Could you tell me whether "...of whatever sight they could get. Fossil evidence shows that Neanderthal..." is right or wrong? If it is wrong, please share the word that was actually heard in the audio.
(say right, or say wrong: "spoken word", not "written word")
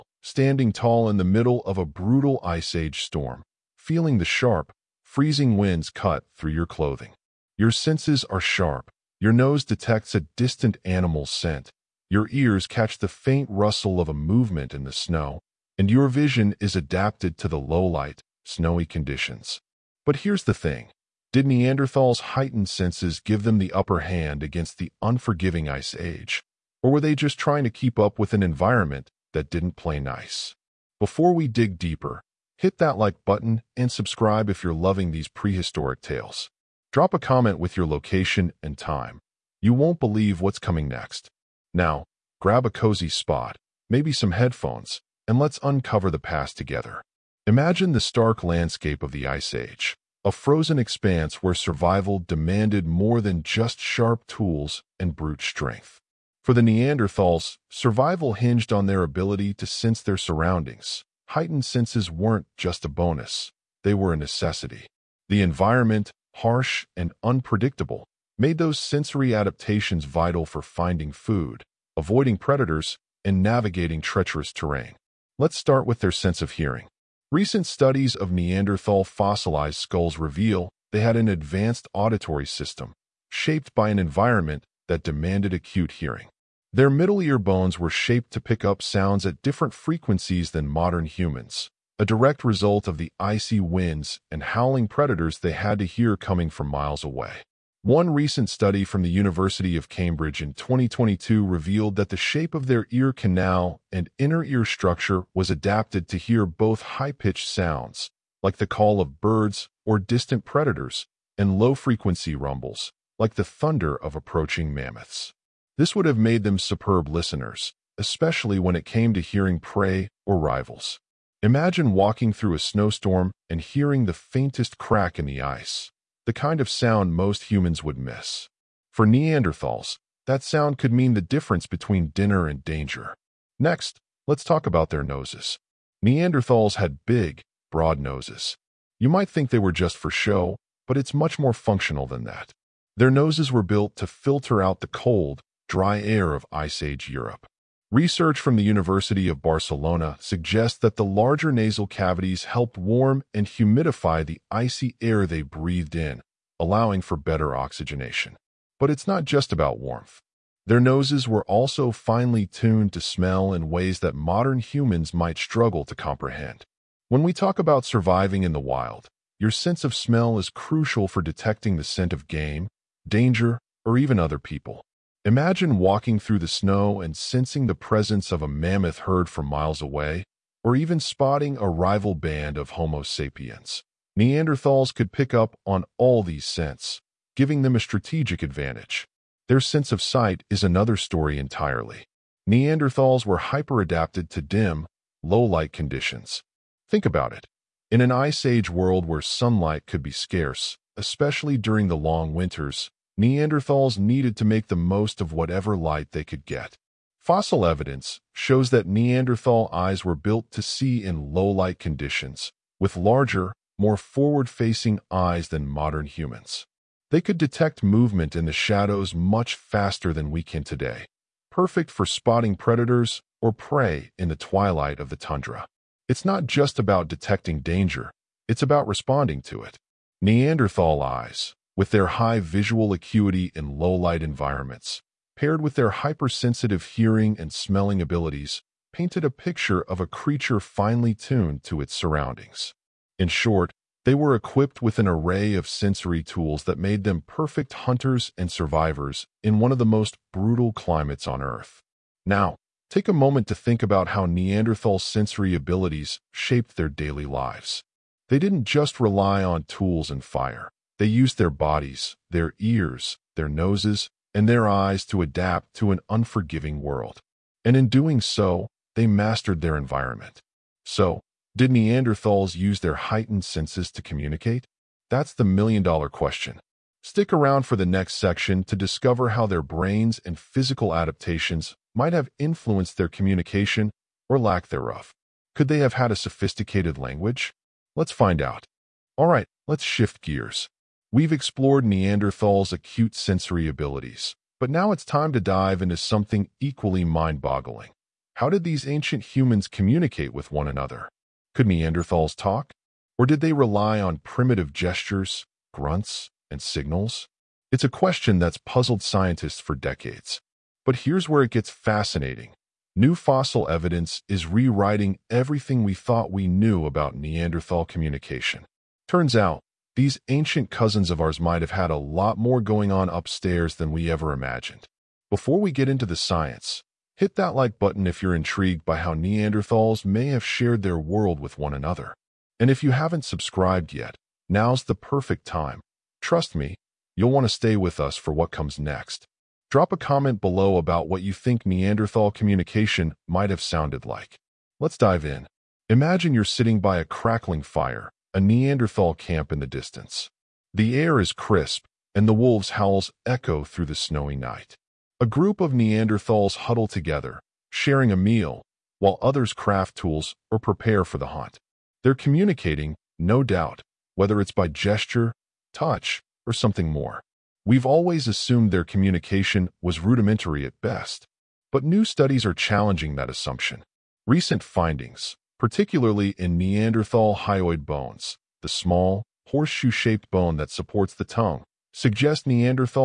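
wrong: "light", not "sight".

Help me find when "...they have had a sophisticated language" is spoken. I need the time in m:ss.
4:45.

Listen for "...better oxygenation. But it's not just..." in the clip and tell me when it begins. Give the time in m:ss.
2:37.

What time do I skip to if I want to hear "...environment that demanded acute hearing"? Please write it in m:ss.
1:23.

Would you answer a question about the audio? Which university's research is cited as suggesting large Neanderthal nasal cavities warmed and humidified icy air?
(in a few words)
University of Barcelona.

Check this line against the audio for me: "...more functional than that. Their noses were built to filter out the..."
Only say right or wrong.
right.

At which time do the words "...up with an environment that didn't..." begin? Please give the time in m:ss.
0:27.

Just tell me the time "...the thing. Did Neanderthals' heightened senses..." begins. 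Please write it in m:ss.
0:20.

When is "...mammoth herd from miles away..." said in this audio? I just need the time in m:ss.
2:58.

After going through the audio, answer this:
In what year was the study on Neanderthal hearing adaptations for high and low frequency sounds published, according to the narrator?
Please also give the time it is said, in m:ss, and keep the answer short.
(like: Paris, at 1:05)
2022, at 1:40.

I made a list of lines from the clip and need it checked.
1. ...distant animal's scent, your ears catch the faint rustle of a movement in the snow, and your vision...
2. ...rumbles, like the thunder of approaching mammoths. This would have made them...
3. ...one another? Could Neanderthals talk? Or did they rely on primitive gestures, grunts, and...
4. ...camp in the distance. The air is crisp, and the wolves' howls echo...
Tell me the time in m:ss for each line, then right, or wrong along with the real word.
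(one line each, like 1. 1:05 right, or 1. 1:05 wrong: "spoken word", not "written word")
1. 0:10 right
2. 1:52 right
3. 5:00 right
4. 5:49 right.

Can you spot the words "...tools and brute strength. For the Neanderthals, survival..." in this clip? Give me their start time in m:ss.
0:54.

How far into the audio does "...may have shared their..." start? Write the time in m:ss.
5:30.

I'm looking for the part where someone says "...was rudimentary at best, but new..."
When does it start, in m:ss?
6:09.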